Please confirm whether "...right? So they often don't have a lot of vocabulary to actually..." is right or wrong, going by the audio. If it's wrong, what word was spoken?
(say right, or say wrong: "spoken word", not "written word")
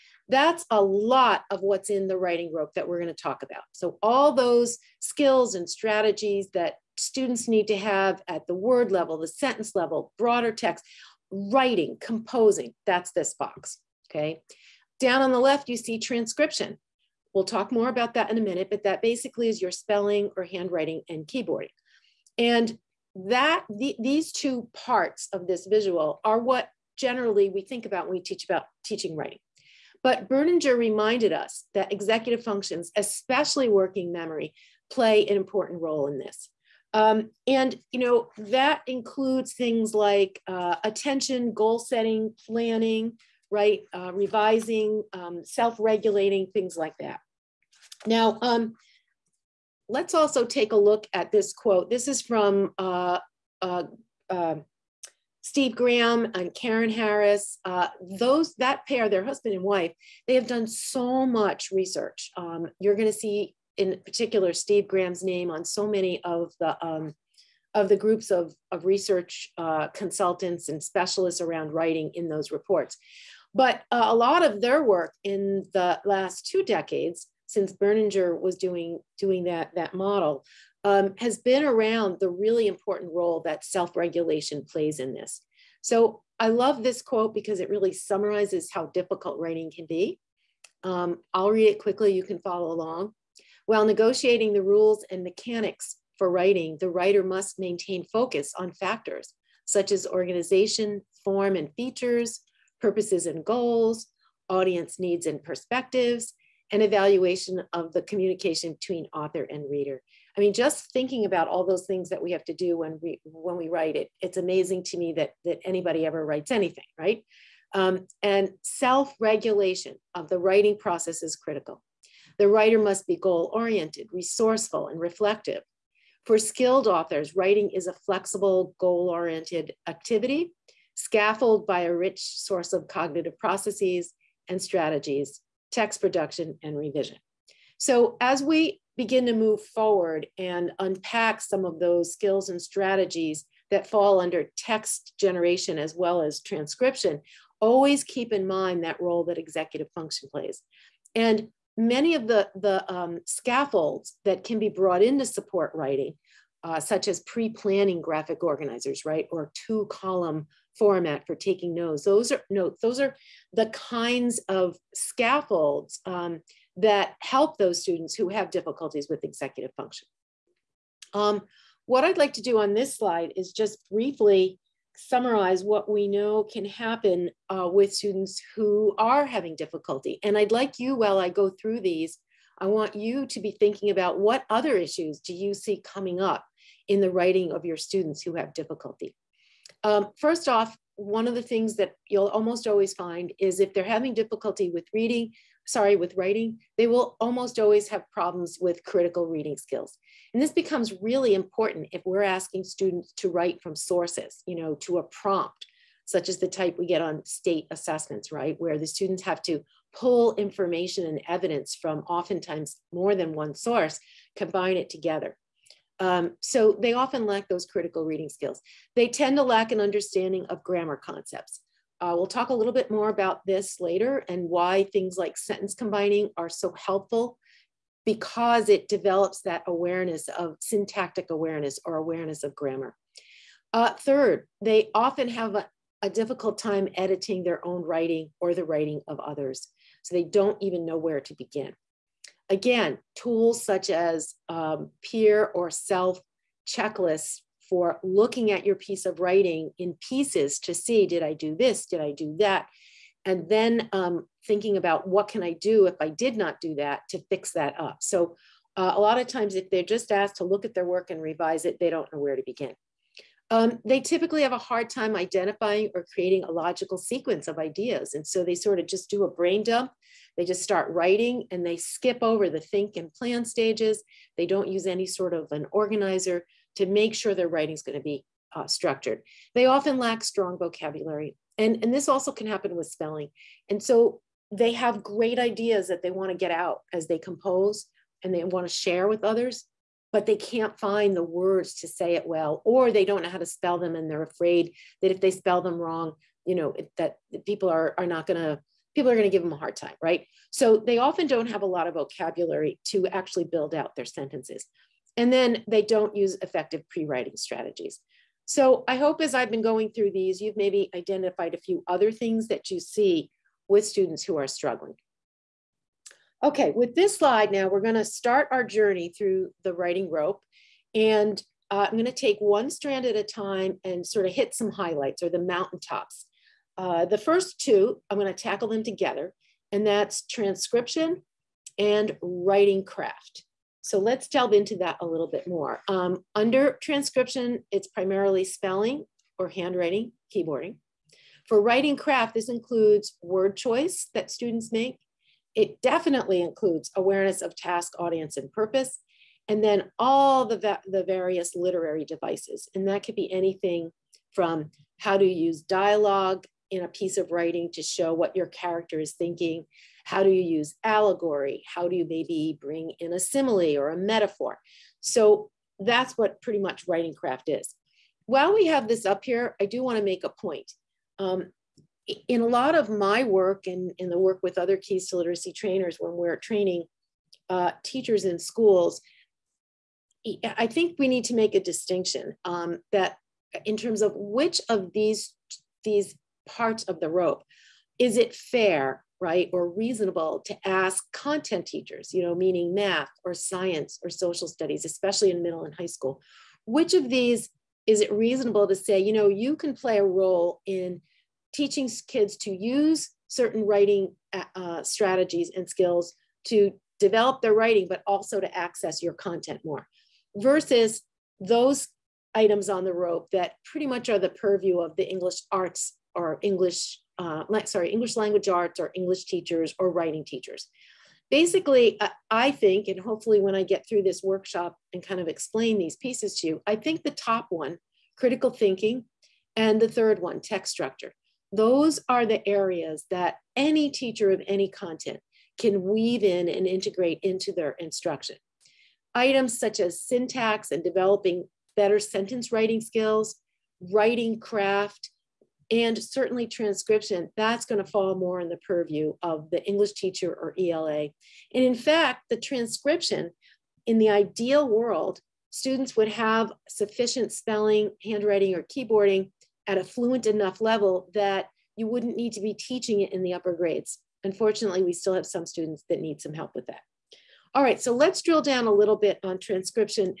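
right.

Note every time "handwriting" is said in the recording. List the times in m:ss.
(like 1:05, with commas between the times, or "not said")
0:20, 5:39, 7:38.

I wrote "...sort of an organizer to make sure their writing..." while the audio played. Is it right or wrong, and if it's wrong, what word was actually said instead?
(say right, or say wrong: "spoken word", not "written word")
right.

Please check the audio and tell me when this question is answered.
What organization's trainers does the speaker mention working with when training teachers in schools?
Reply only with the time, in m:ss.
6:14.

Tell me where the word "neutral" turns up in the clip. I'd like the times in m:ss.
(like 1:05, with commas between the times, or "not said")
not said.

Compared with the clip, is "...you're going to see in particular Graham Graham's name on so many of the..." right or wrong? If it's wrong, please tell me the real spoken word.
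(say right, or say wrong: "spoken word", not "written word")
wrong: "Steve", not "Graham".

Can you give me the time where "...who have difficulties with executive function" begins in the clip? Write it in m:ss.
2:48.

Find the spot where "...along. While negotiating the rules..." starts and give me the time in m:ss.
1:32.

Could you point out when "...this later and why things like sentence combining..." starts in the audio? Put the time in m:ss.
3:43.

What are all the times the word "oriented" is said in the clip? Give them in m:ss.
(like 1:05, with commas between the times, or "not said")
2:03, 2:09.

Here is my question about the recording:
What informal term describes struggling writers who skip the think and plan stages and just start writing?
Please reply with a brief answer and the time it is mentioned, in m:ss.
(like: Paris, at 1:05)
brain dump, at 4:29.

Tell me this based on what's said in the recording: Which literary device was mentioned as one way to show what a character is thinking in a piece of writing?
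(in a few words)
dialogue.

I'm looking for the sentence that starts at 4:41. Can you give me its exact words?
And, and this also can happen with spelling.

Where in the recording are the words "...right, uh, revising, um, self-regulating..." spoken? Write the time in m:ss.
0:43.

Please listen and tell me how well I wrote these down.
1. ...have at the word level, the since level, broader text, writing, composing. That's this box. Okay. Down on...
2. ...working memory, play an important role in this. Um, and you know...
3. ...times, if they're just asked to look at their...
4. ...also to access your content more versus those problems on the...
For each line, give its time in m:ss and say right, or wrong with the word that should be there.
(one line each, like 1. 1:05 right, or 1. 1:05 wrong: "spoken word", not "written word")
1. 0:07 wrong: "sentence", not "since"
2. 0:33 right
3. 4:19 right
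4. 6:48 wrong: "items", not "problems".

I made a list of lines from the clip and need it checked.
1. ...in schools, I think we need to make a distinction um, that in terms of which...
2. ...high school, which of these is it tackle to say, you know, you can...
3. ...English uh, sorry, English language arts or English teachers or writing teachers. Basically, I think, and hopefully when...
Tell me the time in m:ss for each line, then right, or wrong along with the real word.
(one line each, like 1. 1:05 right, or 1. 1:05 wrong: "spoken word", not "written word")
1. 6:18 right
2. 6:35 wrong: "reasonable", not "tackle"
3. 6:56 right.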